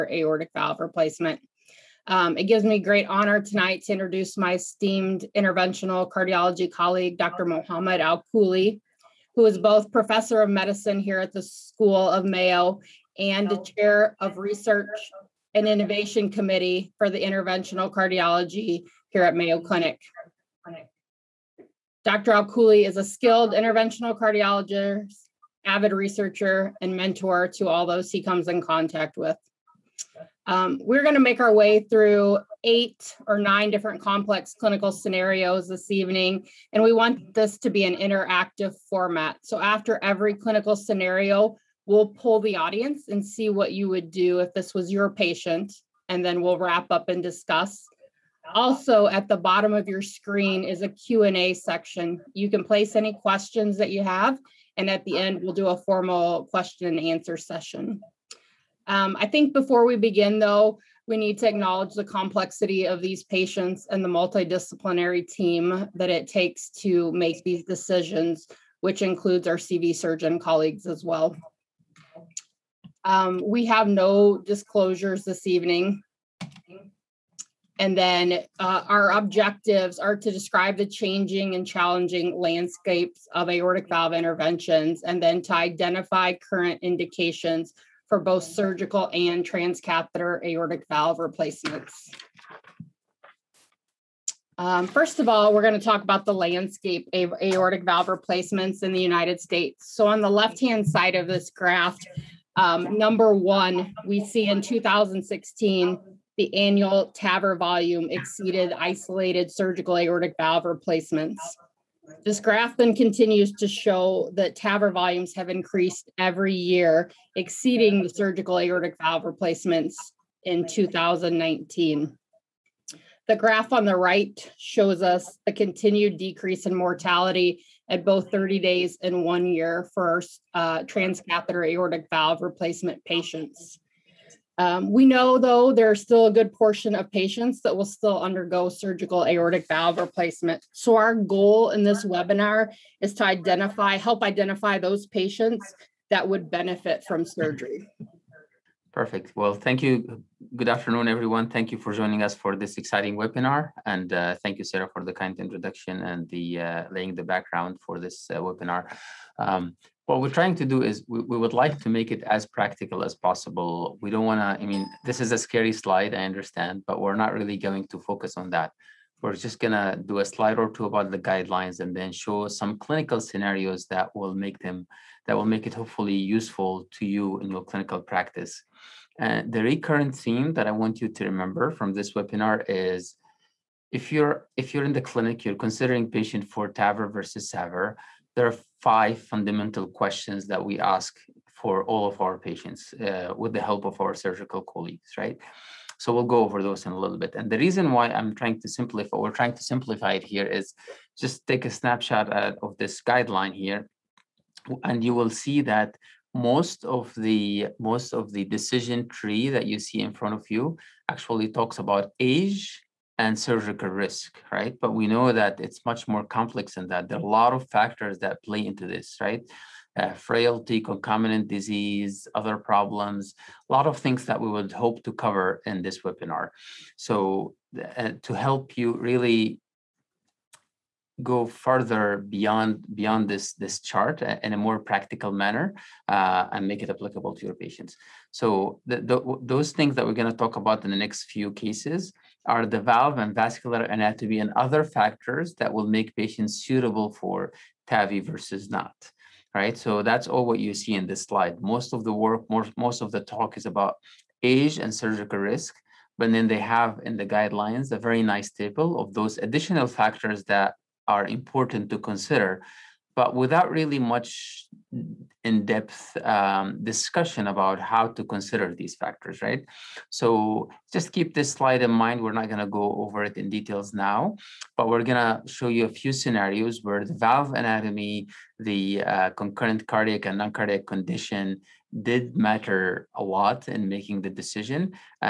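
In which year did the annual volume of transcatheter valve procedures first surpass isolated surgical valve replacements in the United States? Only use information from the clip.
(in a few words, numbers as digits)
2016.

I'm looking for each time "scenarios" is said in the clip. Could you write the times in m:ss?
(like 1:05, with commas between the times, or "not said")
0:34, 0:40, 2:53, 4:36.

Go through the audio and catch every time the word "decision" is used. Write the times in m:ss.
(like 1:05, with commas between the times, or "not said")
1:07, 3:28, 4:44.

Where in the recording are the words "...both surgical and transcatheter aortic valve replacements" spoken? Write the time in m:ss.
1:28.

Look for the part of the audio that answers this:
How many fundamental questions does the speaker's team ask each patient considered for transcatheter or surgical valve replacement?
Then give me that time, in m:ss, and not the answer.
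3:08.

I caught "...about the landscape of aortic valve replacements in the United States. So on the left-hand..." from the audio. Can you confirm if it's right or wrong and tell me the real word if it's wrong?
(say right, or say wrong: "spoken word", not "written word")
right.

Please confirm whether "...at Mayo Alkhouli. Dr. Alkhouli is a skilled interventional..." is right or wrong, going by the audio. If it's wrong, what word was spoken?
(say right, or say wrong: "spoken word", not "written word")
wrong: "Clinic", not "Alkhouli".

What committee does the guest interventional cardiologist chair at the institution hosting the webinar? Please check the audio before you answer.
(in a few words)
research and innovation committee.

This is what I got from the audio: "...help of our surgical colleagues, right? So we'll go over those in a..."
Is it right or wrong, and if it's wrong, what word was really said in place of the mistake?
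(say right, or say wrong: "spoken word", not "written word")
right.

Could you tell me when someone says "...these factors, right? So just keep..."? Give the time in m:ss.
4:28.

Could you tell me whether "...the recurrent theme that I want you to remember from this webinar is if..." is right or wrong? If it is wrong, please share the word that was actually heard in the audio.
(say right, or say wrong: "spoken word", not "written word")
right.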